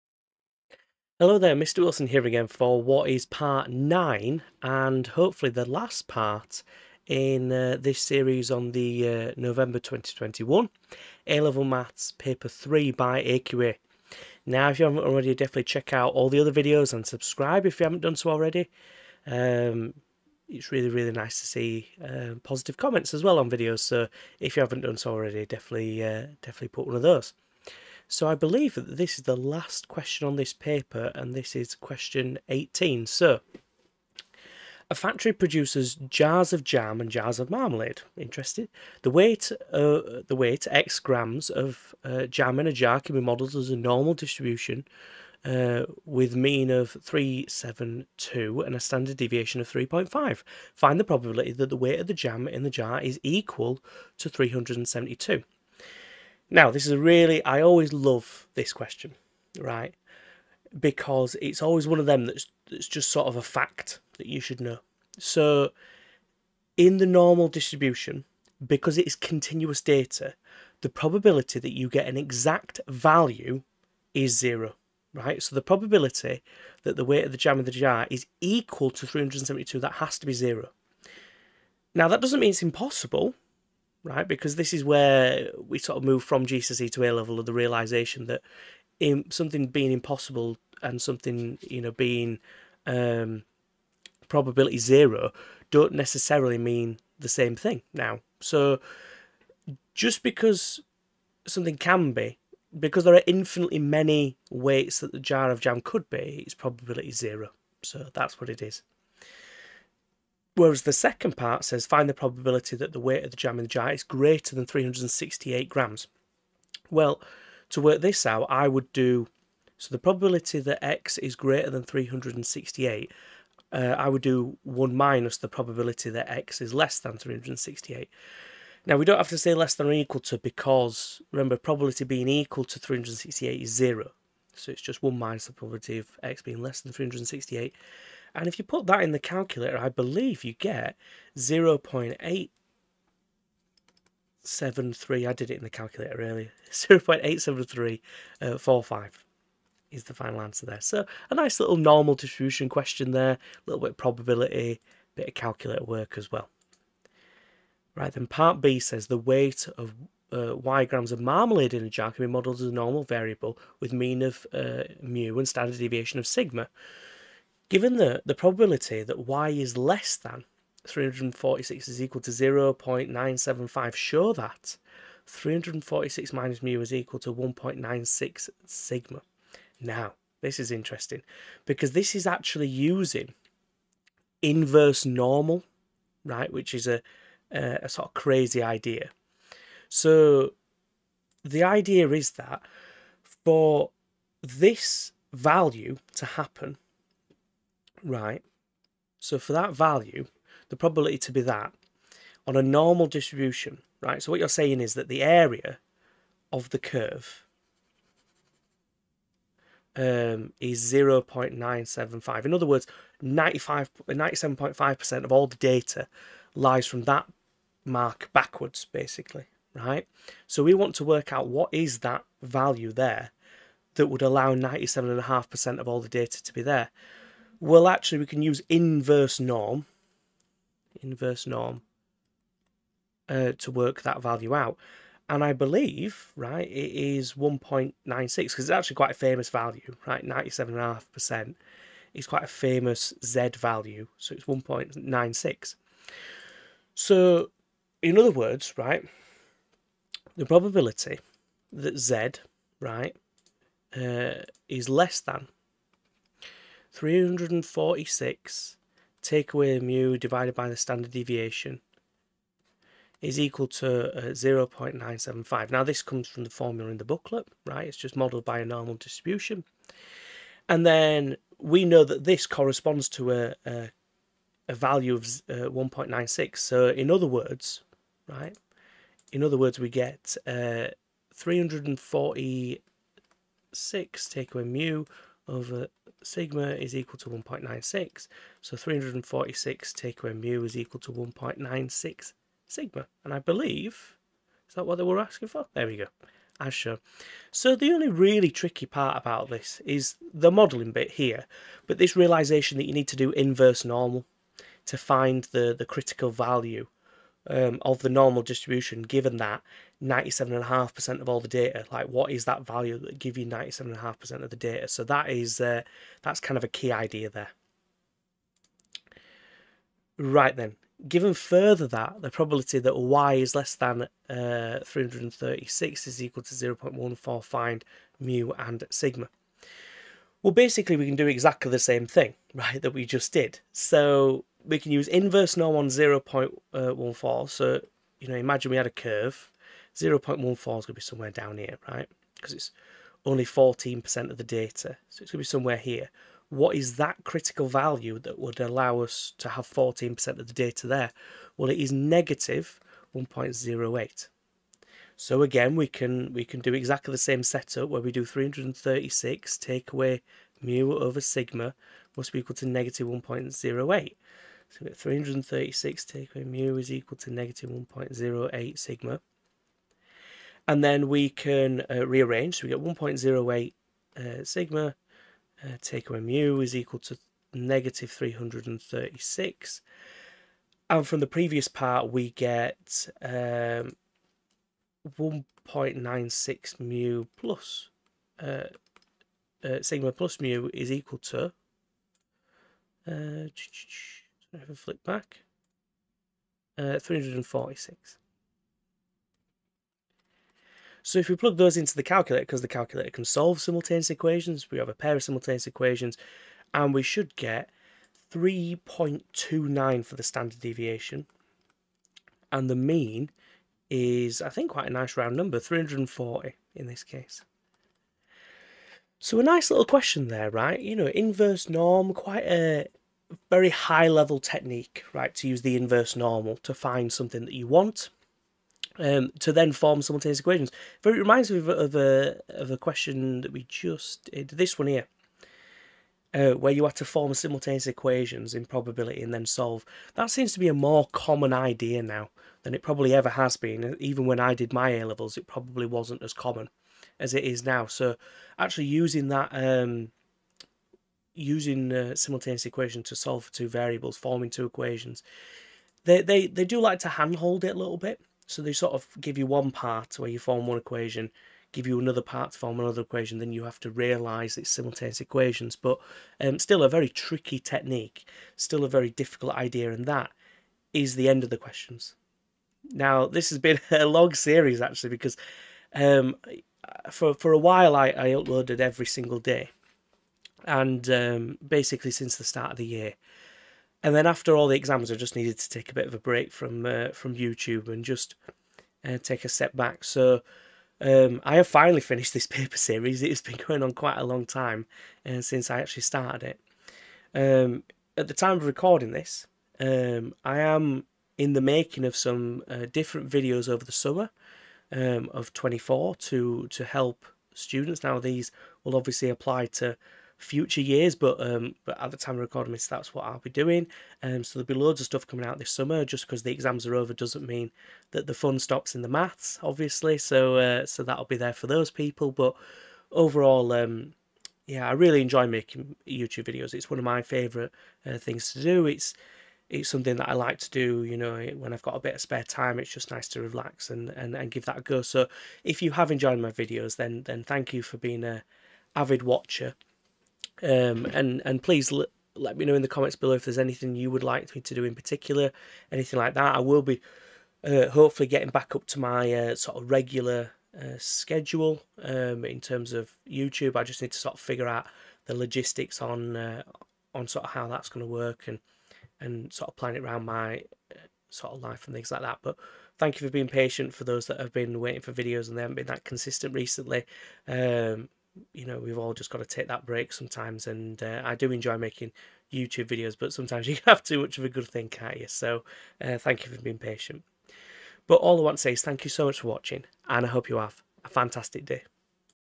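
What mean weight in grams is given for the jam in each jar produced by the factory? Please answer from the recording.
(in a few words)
372.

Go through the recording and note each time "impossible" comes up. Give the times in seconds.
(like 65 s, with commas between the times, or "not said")
82 s, 89 s.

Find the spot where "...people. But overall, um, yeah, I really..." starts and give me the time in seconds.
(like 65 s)
521 s.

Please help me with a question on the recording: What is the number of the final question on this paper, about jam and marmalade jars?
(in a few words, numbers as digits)
18.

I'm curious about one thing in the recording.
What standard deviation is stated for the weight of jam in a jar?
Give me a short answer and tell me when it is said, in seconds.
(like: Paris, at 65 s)
3.5, at 48 s.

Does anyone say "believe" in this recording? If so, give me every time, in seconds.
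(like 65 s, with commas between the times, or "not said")
28 s, 139 s, 235 s, 293 s.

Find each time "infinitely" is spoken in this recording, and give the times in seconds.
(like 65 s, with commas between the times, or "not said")
103 s.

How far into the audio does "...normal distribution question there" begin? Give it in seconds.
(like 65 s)
151 s.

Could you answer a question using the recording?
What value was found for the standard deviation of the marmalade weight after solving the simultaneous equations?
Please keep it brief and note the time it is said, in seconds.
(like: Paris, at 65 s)
3.29, at 408 s.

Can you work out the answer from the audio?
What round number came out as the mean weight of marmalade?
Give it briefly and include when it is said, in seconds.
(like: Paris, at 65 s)
340, at 415 s.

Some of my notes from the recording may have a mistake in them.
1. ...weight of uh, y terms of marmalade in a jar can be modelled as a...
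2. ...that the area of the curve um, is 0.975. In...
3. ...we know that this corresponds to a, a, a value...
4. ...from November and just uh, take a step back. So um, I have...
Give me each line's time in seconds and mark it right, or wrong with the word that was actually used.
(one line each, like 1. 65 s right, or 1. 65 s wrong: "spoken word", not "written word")
1. 159 s wrong: "grams", not "terms"
2. 204 s right
3. 271 s right
4. 487 s wrong: "YouTube", not "November".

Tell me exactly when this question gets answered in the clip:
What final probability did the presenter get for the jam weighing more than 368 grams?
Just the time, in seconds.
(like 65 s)
146 s.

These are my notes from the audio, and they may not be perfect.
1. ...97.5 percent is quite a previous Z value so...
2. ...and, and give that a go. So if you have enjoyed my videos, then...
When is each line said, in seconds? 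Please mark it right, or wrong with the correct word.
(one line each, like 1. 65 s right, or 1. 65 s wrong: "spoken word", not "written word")
1. 240 s wrong: "famous", not "previous"
2. 534 s right.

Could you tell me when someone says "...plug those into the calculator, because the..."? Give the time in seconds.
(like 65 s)
401 s.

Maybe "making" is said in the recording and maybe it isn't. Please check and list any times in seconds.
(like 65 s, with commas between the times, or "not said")
501 s, 525 s, 571 s.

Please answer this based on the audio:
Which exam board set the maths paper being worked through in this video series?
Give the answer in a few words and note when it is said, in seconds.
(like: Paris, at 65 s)
AQA, at 13 s.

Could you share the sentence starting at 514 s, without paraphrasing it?
Um, so there'll be loads of stuff coming out this summer.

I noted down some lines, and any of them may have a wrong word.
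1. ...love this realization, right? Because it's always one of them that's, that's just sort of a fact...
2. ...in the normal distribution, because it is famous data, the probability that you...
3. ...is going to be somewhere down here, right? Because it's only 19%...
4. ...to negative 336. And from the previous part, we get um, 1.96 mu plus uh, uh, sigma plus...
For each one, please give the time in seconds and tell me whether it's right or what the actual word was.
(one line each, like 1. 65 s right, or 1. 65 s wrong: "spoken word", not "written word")
1. 57 s wrong: "question", not "realization"
2. 66 s wrong: "continuous", not "famous"
3. 340 s wrong: "14", not "19"
4. 377 s right.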